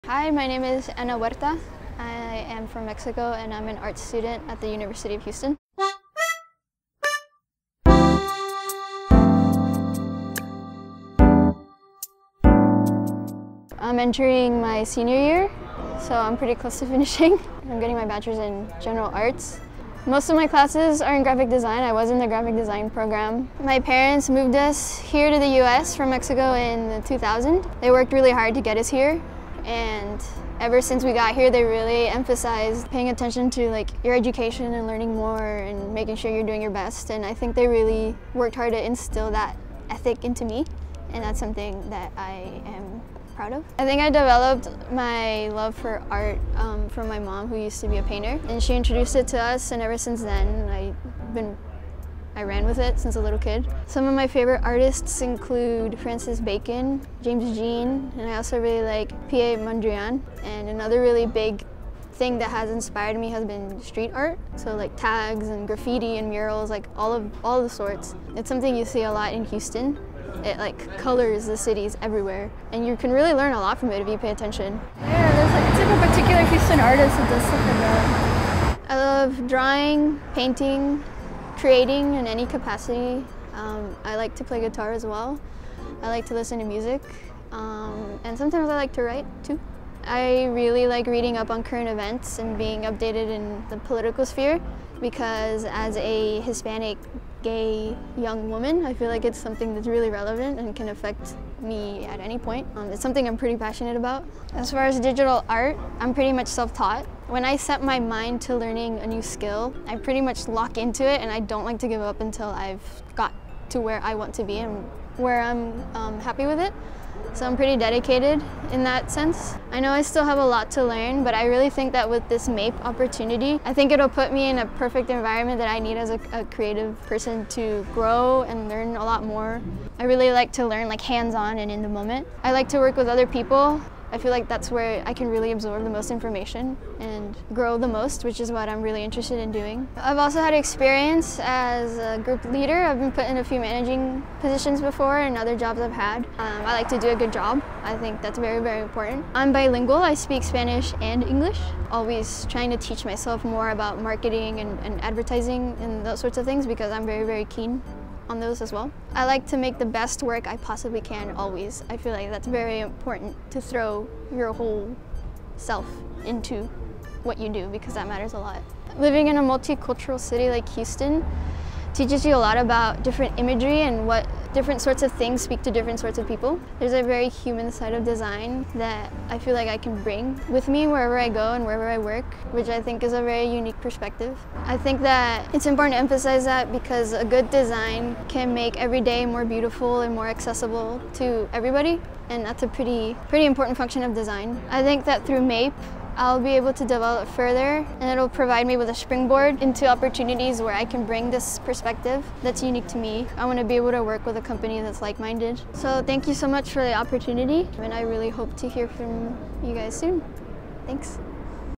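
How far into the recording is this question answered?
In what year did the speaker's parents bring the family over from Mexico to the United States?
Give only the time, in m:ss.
0:27.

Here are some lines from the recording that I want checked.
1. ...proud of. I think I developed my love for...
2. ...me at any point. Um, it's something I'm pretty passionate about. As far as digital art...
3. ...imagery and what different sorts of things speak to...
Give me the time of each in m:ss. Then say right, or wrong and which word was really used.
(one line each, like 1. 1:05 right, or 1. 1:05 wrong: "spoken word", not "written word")
1. 0:43 right
2. 1:41 right
3. 2:53 right.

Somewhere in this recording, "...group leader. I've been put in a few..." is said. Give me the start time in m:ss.
2:22.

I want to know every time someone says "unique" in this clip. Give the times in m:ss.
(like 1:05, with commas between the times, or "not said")
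3:03, 3:22.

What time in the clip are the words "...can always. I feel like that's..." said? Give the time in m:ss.
2:41.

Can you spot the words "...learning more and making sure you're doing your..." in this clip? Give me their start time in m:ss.
0:34.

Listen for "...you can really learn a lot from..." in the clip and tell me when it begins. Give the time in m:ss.
1:12.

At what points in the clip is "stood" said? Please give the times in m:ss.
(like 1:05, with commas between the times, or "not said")
not said.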